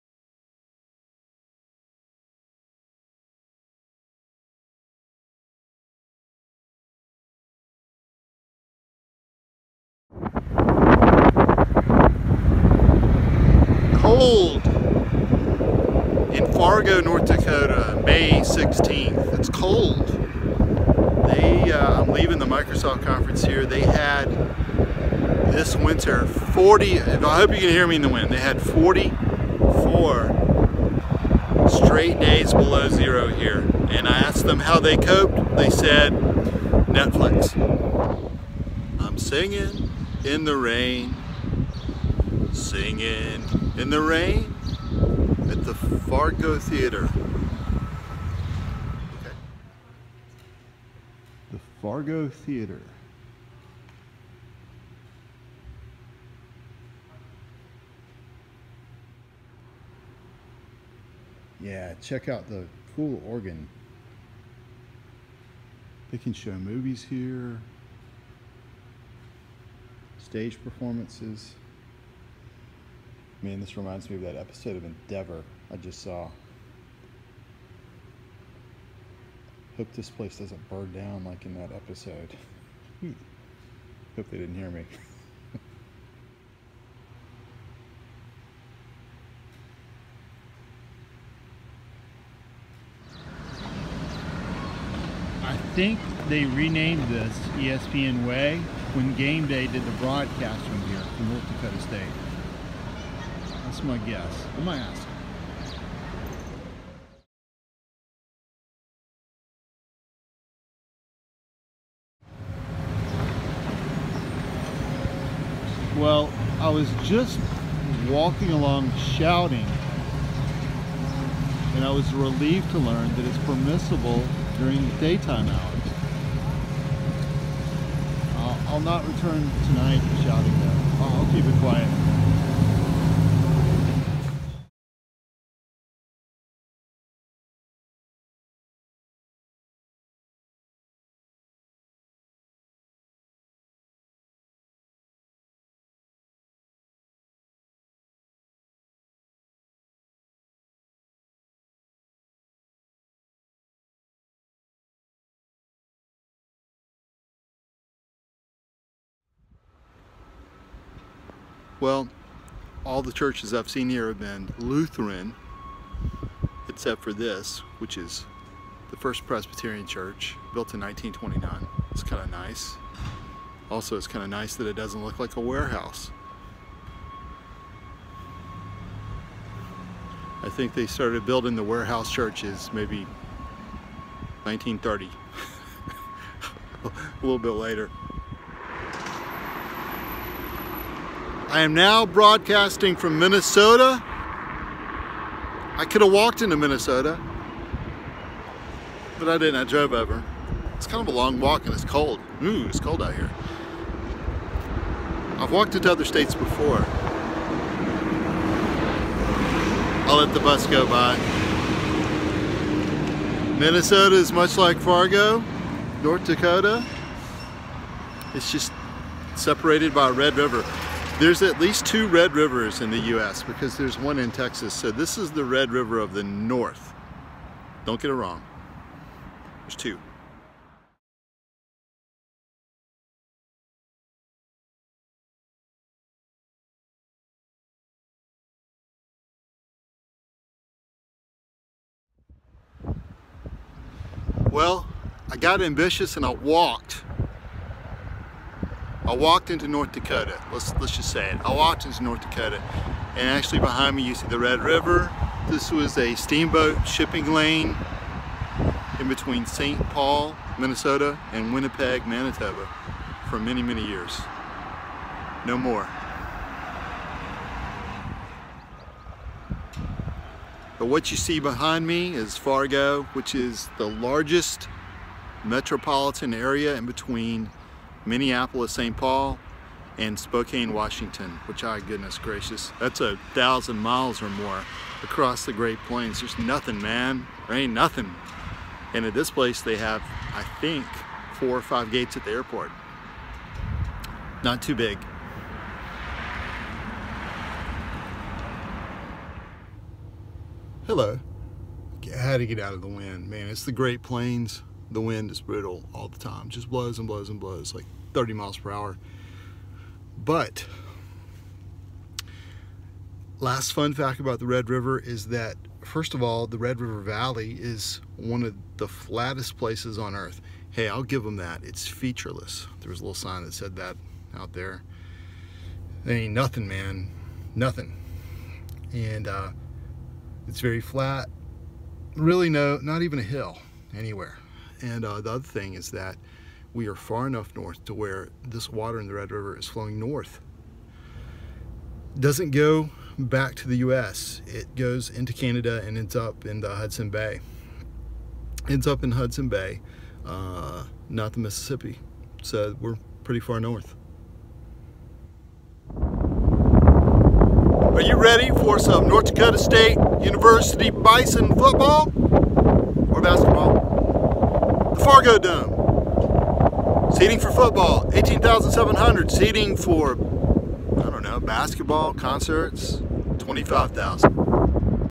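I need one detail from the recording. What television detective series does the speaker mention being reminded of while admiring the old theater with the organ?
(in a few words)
Endeavour.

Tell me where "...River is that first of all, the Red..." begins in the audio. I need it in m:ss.
5:14.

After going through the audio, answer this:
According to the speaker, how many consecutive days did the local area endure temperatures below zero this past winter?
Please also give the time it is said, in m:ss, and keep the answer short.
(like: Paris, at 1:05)
44, at 0:28.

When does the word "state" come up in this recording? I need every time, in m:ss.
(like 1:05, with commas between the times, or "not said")
1:41, 3:26, 5:59.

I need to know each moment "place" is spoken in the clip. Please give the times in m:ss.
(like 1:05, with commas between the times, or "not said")
1:20, 4:49, 5:19.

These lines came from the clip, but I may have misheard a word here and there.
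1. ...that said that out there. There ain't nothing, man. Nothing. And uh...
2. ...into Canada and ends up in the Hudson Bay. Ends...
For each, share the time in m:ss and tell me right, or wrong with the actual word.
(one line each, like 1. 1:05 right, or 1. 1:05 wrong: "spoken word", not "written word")
1. 5:23 right
2. 5:45 right.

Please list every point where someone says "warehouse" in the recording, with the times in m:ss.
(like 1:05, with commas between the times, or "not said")
2:55, 3:01.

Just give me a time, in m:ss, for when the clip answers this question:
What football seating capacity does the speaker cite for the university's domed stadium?
6:08.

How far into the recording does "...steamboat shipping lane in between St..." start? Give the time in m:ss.
4:16.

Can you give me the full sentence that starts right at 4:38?
Paul, and Spokane, Washington, which, oh goodness gracious, that's a thousand miles or more across the Great Plains.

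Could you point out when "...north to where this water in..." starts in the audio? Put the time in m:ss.
5:37.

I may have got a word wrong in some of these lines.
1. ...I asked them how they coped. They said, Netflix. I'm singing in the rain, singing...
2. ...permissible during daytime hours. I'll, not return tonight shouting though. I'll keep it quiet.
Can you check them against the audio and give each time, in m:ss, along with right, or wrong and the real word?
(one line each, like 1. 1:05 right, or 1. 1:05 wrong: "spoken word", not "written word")
1. 0:34 right
2. 2:03 right.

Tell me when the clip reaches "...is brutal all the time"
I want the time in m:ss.
5:05.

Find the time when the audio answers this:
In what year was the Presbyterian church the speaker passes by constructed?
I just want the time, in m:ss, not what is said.
2:50.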